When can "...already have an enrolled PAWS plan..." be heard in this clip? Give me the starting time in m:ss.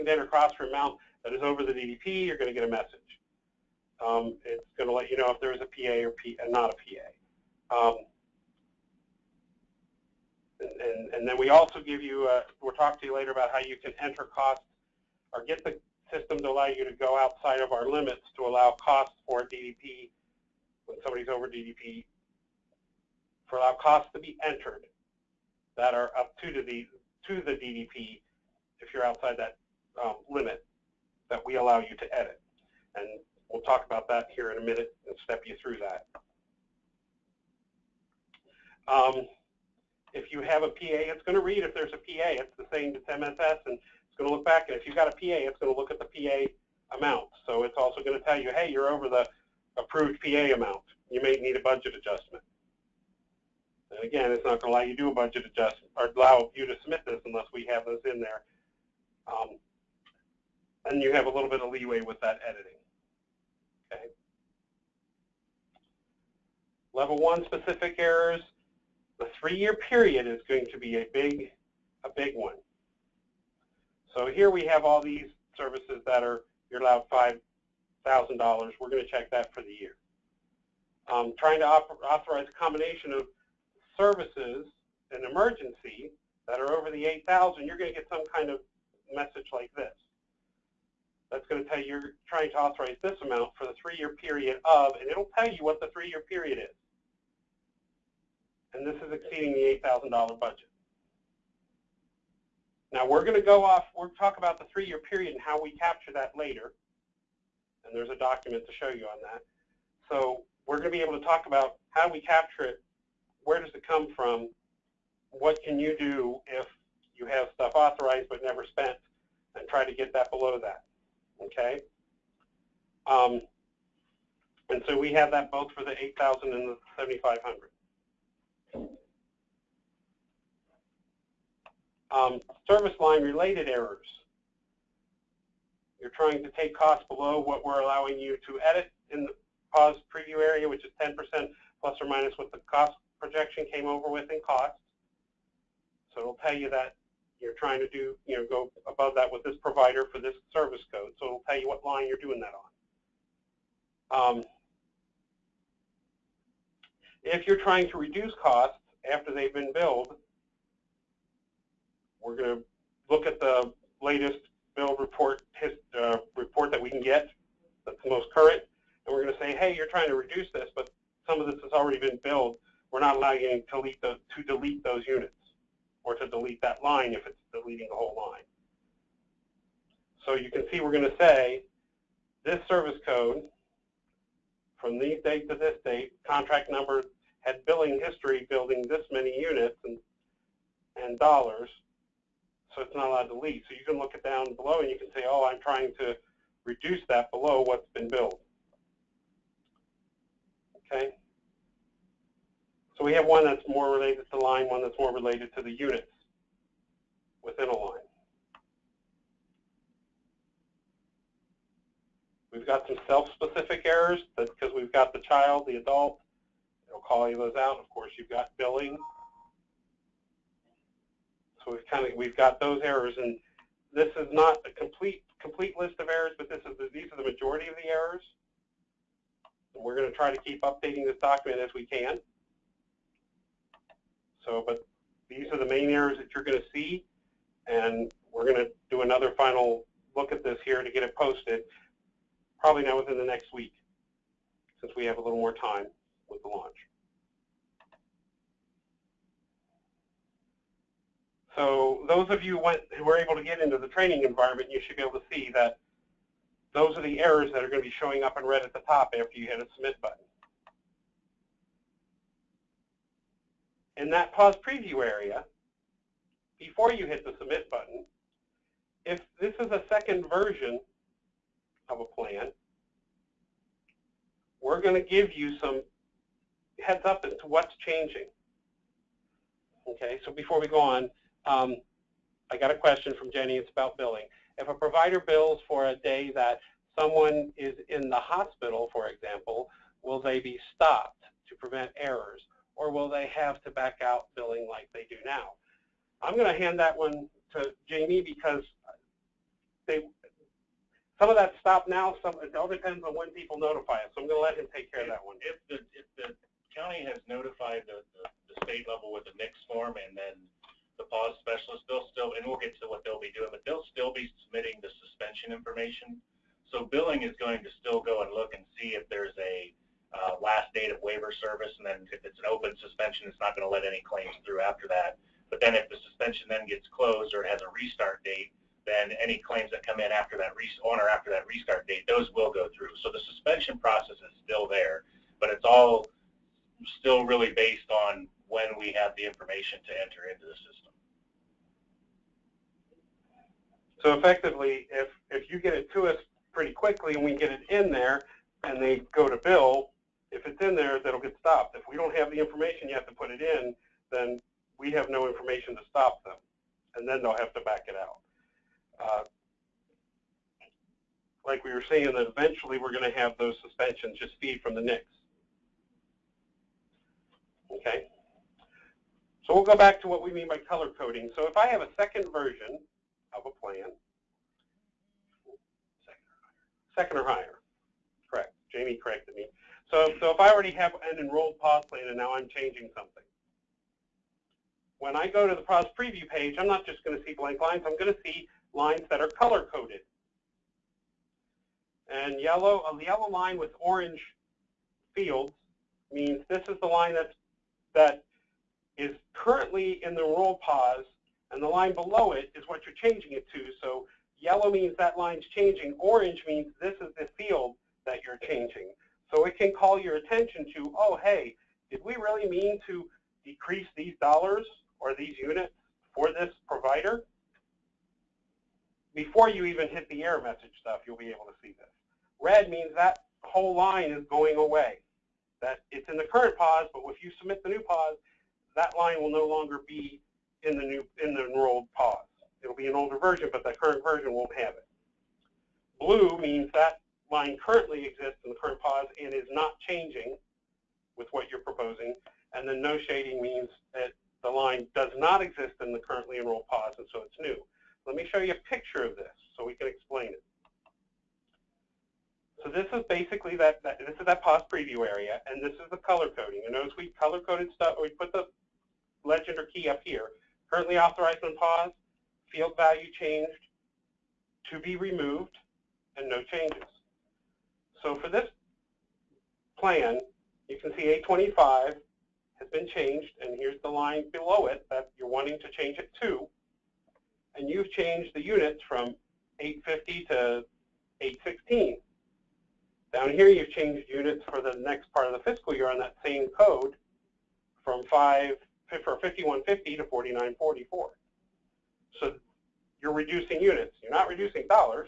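6:20.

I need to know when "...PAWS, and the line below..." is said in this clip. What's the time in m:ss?
6:40.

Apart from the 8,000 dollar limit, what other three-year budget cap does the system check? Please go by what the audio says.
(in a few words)
$7,500.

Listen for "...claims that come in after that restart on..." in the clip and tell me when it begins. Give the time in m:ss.
5:29.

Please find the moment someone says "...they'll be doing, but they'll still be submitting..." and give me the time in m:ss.
5:13.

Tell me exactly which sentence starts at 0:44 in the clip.
And if you've got a PA, it's going to look at the PA amount.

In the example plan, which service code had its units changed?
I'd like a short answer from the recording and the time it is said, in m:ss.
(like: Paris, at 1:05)
825, at 7:51.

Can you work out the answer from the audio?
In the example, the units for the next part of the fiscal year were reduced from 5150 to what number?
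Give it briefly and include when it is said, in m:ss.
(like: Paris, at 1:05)
4944, at 8:10.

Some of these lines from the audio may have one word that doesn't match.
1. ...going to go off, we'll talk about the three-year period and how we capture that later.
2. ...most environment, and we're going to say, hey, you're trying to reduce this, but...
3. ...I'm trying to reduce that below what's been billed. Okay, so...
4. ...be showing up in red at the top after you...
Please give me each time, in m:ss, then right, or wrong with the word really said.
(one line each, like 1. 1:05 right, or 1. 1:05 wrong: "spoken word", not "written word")
1. 1:43 right
2. 2:48 wrong: "current", not "environment"
3. 3:15 right
4. 4:17 right.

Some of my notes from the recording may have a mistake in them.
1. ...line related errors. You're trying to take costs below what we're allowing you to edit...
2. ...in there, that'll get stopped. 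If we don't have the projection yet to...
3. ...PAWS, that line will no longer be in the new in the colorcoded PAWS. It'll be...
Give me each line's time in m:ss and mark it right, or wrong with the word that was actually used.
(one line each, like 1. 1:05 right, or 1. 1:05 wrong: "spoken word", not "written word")
1. 2:12 right
2. 5:50 wrong: "information", not "projection"
3. 7:07 wrong: "enrolled", not "colorcoded".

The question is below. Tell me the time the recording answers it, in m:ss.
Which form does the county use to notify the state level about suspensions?
5:09.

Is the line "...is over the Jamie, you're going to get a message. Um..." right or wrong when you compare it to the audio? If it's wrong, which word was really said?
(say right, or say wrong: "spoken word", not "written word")
wrong: "DDP", not "Jamie".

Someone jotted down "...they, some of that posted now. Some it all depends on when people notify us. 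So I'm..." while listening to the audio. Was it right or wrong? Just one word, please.
wrong.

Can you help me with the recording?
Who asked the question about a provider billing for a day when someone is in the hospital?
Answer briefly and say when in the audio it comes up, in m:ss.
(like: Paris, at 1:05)
Jenny, at 4:43.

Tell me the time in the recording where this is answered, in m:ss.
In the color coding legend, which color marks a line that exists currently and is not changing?
7:15.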